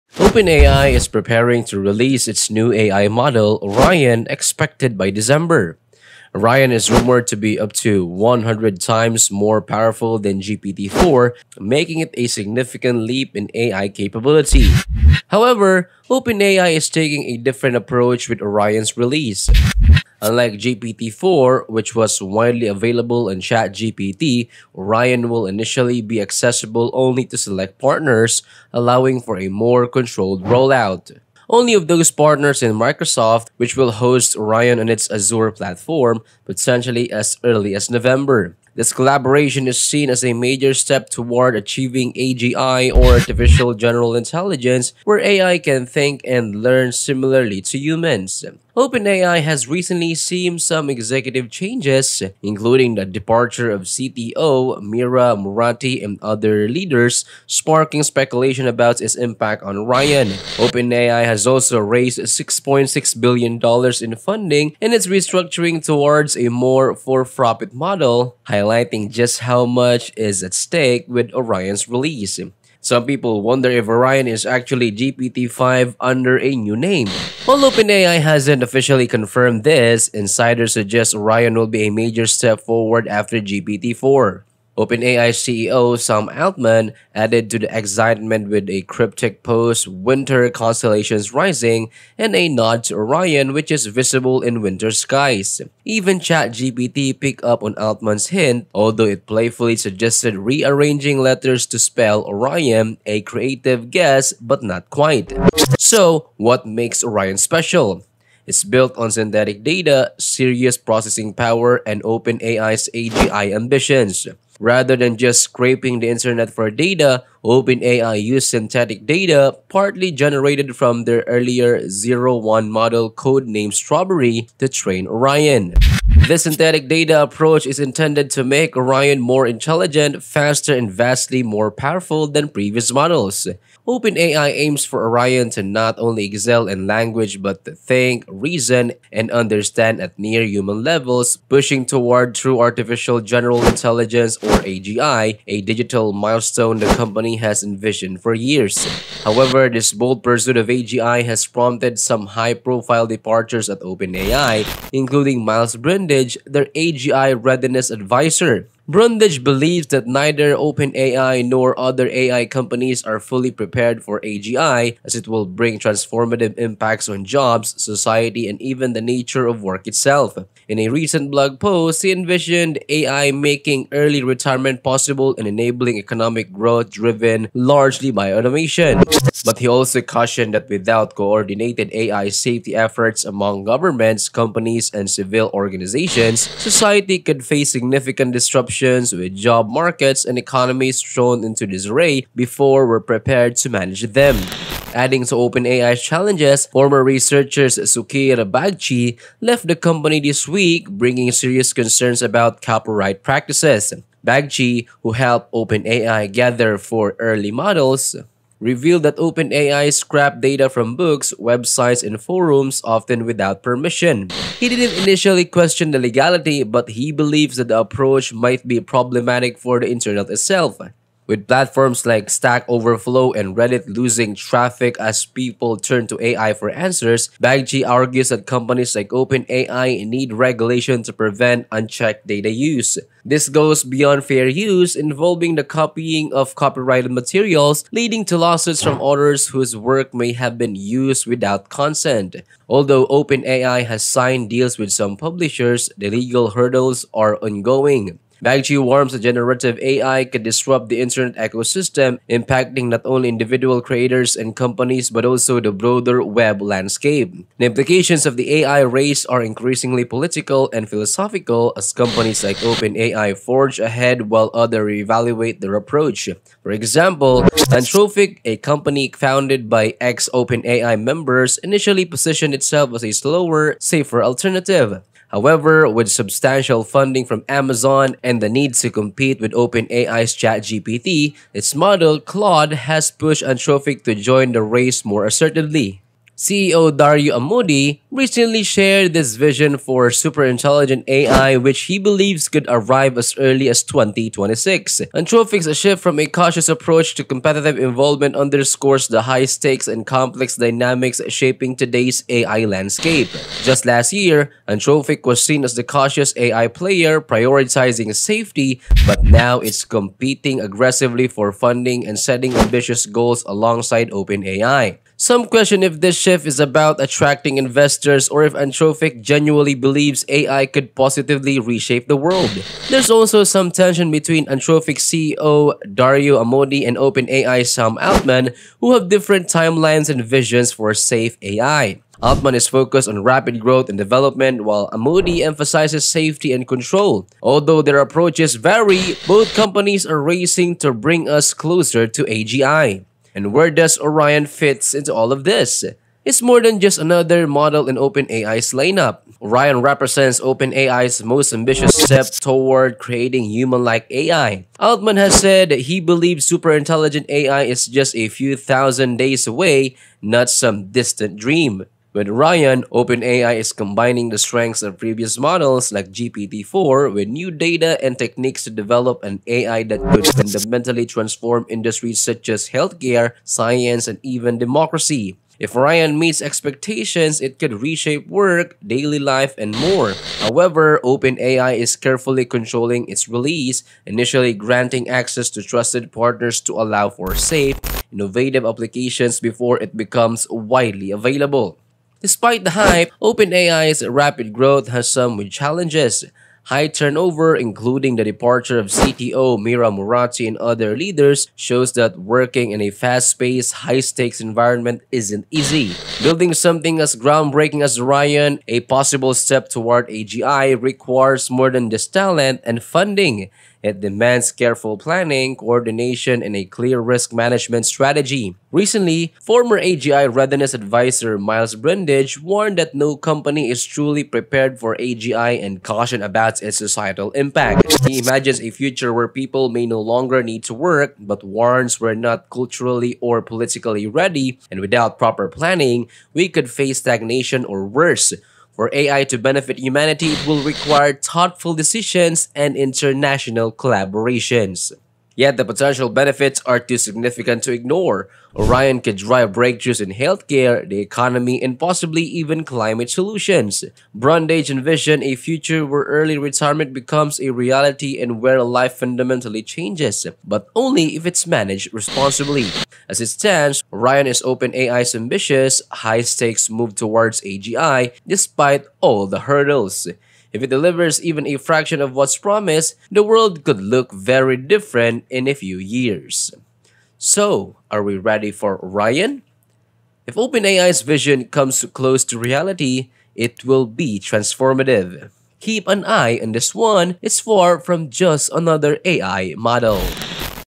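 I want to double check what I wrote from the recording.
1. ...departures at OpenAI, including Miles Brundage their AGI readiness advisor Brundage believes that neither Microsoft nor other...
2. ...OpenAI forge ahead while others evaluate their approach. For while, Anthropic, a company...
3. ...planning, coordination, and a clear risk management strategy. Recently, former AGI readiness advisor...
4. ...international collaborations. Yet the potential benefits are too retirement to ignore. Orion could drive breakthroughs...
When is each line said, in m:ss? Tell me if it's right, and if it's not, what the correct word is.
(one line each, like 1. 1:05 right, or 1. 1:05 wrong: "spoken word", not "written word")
1. 2:33 wrong: "OpenAI", not "Microsoft"
2. 4:22 wrong: "example", not "while"
3. 6:54 right
4. 7:22 wrong: "significant", not "retirement".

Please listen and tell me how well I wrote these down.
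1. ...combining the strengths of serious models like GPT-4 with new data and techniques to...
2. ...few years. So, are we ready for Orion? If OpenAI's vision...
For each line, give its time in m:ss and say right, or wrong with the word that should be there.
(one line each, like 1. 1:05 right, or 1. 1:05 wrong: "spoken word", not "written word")
1. 6:03 wrong: "previous", not "serious"
2. 7:55 right.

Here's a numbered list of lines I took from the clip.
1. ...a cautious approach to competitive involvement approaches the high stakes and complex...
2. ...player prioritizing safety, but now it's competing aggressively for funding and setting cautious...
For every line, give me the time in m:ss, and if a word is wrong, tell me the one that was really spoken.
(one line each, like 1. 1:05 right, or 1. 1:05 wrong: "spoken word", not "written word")
1. 4:56 wrong: "underscores", not "approaches"
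2. 5:06 wrong: "ambitious", not "cautious".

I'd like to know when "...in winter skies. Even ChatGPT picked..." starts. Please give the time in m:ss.
1:34.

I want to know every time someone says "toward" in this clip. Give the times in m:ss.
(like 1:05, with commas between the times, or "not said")
0:41, 1:05, 2:21, 5:52, 6:49, 7:46.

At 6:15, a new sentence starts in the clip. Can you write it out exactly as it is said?
If Orion meets expectations, it could reshape work, daily life, and more.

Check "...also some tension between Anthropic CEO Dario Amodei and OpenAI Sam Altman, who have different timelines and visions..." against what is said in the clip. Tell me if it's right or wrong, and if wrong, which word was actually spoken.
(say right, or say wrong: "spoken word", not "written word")
right.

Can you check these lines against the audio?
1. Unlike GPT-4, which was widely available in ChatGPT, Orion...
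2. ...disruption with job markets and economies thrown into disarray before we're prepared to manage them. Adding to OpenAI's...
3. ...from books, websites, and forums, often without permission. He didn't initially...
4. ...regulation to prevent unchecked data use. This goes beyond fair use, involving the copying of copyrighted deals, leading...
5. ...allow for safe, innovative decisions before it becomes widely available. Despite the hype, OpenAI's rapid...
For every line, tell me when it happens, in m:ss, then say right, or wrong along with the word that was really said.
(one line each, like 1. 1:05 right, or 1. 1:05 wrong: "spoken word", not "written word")
1. 0:20 right
2. 3:08 right
3. 3:30 right
4. 3:50 wrong: "materials", not "deals"
5. 6:26 wrong: "applications", not "decisions".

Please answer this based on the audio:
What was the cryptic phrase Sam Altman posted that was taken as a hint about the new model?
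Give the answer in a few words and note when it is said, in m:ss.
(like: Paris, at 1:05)
Winter Constellations Rising, at 1:29.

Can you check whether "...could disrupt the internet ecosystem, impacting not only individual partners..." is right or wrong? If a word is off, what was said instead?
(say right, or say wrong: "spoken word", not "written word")
wrong: "creators", not "partners".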